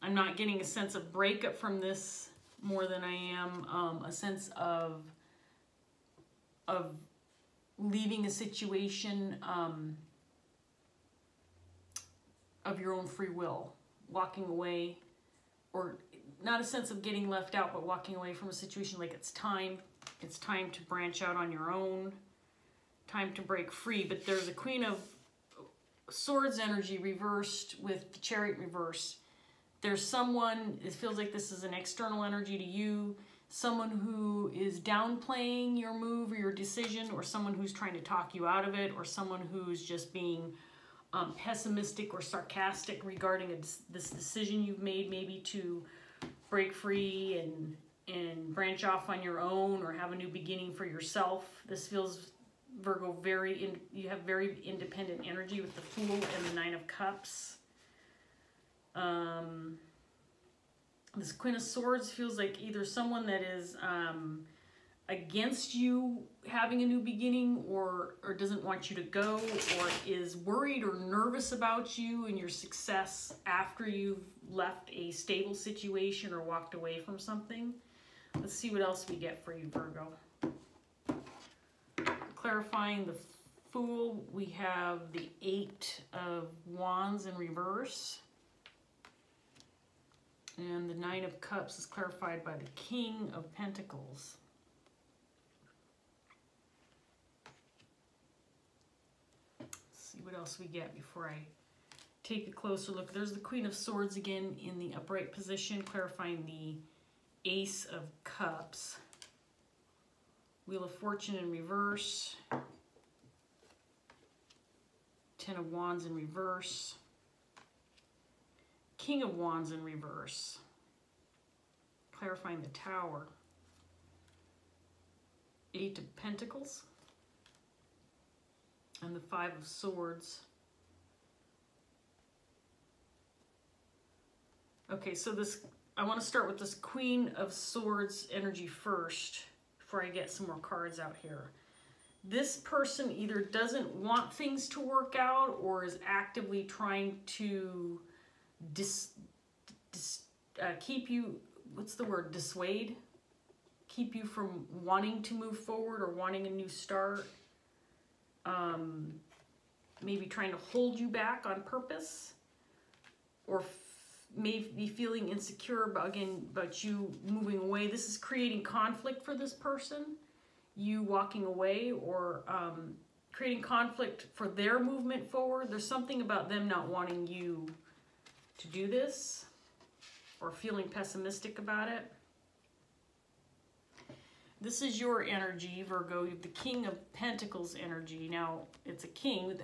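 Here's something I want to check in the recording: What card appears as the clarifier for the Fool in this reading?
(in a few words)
Eight of Wands.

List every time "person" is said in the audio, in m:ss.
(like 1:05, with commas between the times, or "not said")
2:22, 2:49.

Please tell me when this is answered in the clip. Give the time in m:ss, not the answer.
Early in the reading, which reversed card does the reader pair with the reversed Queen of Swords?
0:28.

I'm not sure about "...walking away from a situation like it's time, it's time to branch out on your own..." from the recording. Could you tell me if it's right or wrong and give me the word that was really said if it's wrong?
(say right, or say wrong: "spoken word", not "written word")
right.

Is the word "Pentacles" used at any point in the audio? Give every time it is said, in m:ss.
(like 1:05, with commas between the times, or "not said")
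1:33, 2:06, 3:07.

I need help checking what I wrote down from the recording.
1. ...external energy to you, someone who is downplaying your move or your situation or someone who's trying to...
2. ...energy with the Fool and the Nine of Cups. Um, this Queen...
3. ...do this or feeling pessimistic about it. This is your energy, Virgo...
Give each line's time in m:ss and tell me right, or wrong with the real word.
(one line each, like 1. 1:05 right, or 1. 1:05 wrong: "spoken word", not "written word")
1. 0:31 wrong: "decision", not "situation"
2. 0:55 right
3. 2:58 right.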